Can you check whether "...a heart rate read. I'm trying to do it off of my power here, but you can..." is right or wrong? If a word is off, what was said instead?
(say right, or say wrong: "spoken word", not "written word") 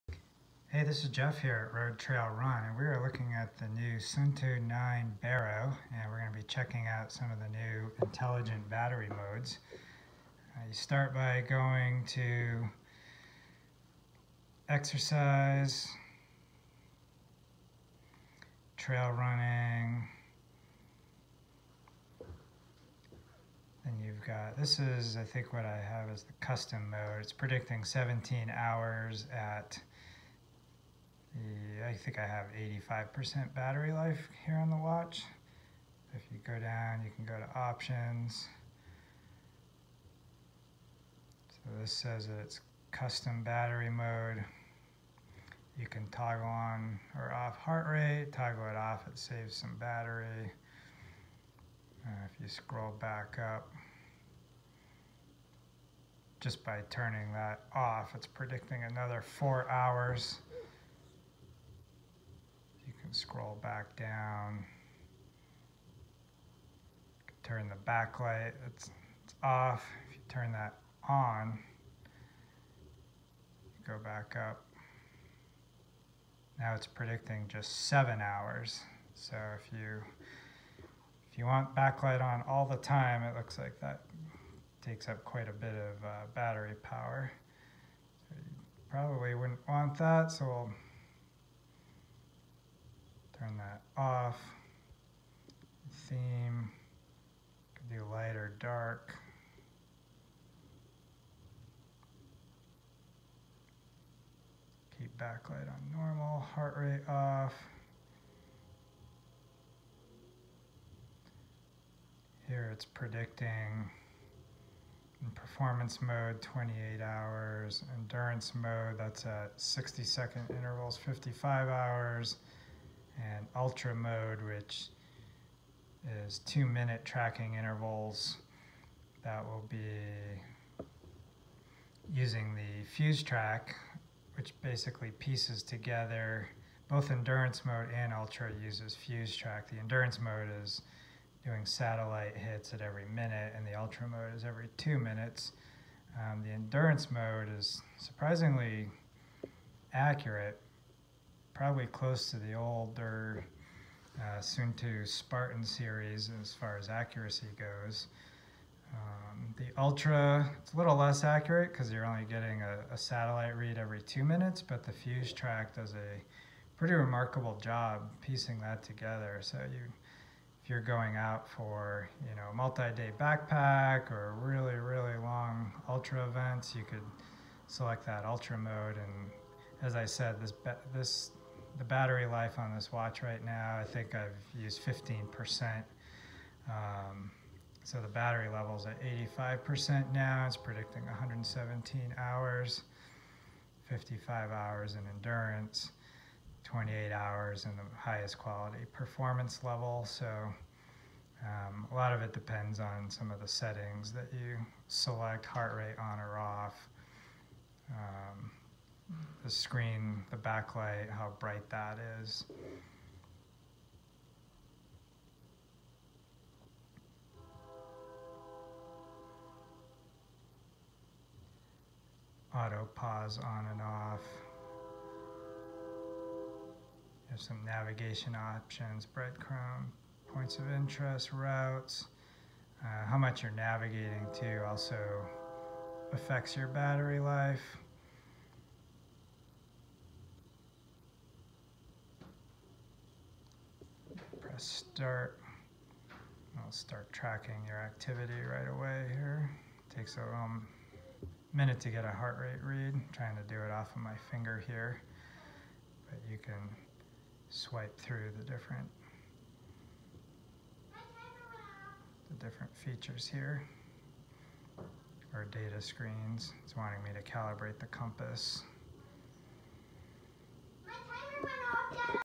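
wrong: "finger", not "power".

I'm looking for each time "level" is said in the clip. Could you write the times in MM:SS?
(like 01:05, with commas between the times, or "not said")
03:08, 03:19.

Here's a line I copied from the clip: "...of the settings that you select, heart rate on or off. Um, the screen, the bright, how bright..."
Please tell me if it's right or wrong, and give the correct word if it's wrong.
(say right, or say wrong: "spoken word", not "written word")
wrong: "backlight", not "bright".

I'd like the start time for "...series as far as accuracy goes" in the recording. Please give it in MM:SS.
02:35.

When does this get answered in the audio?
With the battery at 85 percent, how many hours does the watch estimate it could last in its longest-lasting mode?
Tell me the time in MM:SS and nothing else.
03:11.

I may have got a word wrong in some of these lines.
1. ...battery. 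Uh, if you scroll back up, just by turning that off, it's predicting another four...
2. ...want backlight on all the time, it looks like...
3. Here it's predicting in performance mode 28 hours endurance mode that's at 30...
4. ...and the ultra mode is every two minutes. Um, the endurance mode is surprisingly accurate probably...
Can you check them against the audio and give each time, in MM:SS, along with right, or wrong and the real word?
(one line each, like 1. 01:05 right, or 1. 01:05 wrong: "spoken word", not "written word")
1. 00:49 right
2. 01:21 right
3. 01:52 wrong: "60", not "30"
4. 02:23 right.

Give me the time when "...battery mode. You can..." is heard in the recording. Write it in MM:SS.
00:43.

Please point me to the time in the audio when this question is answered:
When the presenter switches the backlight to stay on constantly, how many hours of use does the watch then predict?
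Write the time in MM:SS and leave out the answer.
01:17.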